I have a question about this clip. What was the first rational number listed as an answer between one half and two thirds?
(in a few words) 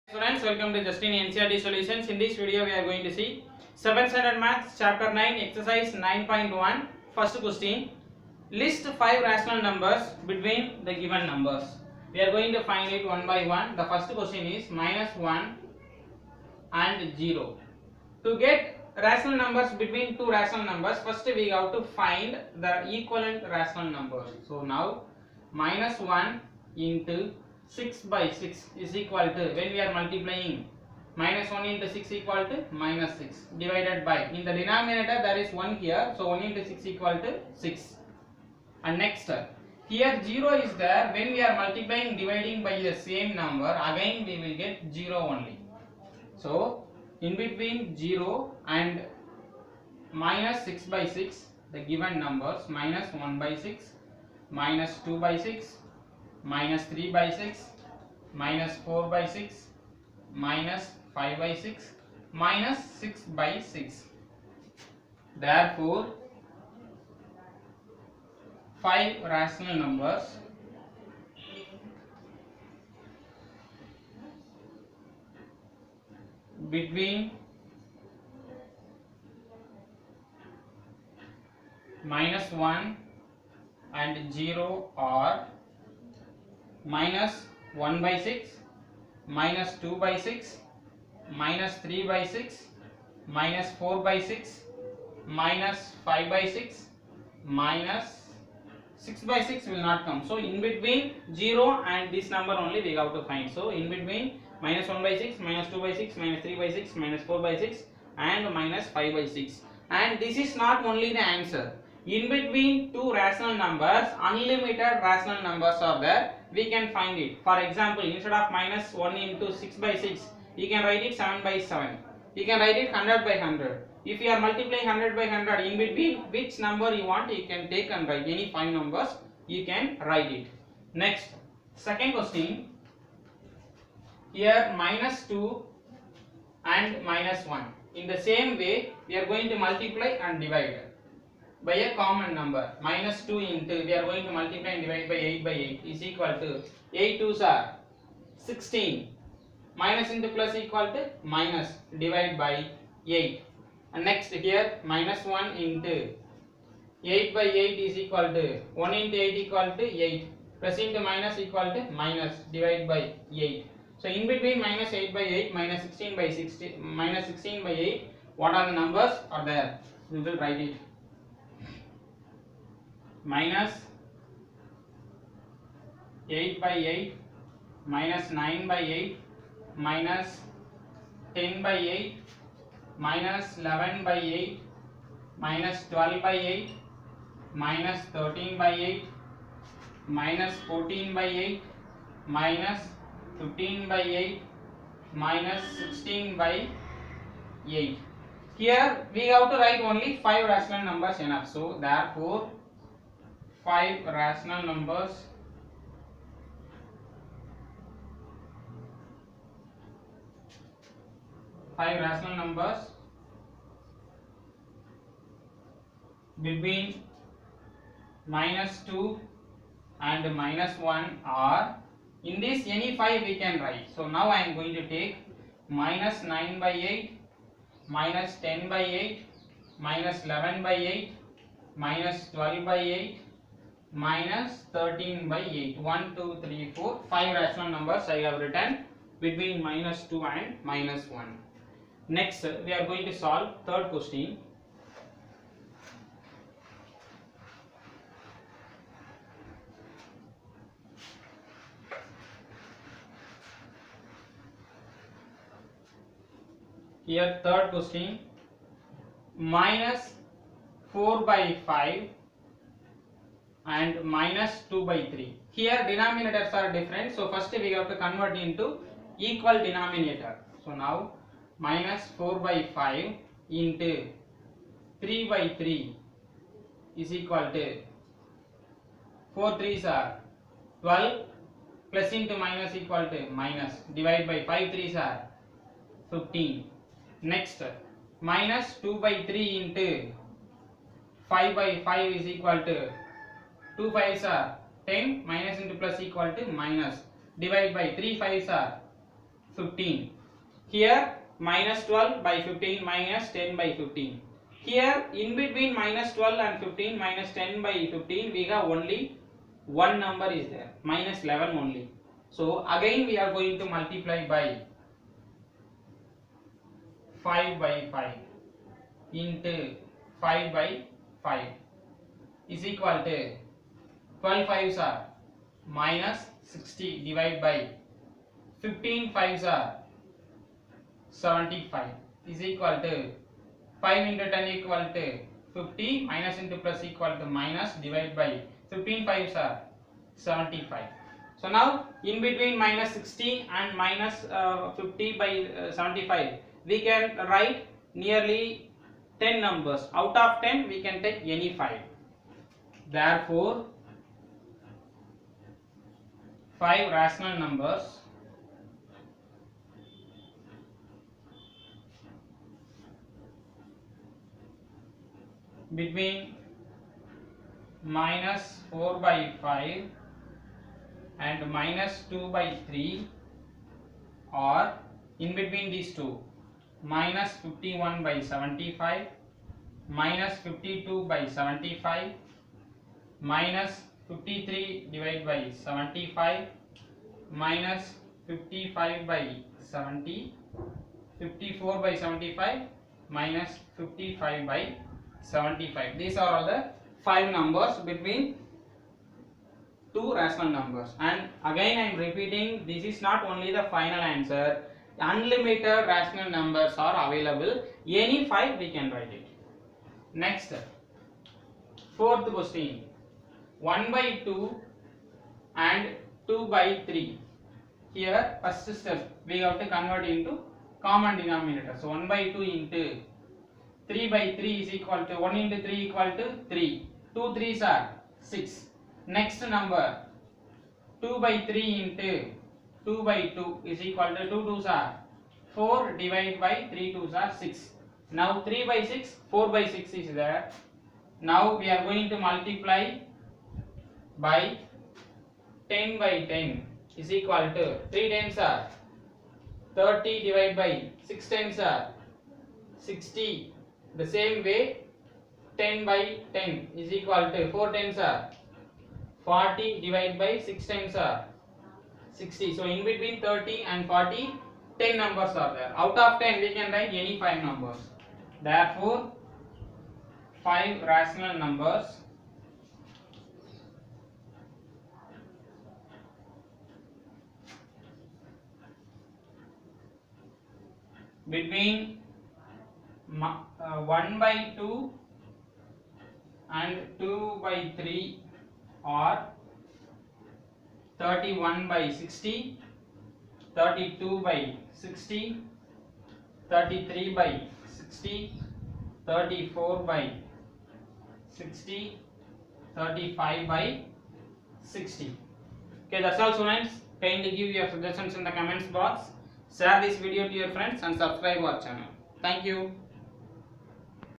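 31/60.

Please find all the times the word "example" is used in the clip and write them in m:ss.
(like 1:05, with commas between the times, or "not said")
1:57.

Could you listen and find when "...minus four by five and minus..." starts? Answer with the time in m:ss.
4:19.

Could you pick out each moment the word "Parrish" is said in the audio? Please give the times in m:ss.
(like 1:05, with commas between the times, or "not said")
not said.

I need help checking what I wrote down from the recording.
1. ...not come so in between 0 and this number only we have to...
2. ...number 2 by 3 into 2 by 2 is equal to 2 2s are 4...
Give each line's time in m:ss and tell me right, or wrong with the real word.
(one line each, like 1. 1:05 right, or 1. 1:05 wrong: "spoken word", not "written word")
1. 1:39 right
2. 7:09 right.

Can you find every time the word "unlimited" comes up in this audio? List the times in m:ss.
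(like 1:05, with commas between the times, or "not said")
1:54, 6:45.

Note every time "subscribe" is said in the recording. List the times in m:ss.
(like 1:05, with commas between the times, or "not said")
8:30.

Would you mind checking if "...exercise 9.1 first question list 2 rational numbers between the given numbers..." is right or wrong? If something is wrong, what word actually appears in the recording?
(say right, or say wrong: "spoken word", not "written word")
wrong: "5", not "2".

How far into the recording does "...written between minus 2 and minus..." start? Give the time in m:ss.
3:58.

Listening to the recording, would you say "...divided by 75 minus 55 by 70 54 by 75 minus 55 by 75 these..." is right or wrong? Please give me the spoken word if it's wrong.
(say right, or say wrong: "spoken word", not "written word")
right.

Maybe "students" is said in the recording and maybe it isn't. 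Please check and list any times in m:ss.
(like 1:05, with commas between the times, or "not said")
0:00, 8:26.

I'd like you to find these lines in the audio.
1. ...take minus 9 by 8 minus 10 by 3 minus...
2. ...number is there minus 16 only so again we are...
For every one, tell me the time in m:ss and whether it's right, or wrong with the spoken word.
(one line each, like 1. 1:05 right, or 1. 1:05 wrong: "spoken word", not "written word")
1. 3:44 wrong: "8", not "3"
2. 5:10 wrong: "11", not "16".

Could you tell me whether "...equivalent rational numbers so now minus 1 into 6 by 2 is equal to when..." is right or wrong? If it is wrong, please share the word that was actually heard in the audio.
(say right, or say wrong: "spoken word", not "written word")
wrong: "6", not "2".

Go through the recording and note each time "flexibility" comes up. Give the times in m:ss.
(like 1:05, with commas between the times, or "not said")
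not said.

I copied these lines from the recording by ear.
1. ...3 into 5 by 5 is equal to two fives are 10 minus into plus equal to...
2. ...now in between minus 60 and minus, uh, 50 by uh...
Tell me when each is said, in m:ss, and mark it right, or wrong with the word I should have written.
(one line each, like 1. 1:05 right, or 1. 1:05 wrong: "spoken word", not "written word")
1. 4:49 right
2. 5:41 right.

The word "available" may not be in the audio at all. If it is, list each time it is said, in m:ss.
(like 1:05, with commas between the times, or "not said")
6:47.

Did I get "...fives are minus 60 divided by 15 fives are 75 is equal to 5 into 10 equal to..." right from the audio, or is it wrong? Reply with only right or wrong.
right.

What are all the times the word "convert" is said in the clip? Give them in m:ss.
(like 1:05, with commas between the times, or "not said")
4:27, 6:59.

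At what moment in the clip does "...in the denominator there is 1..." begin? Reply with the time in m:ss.
0:34.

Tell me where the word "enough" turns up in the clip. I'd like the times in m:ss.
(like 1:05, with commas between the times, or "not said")
3:21.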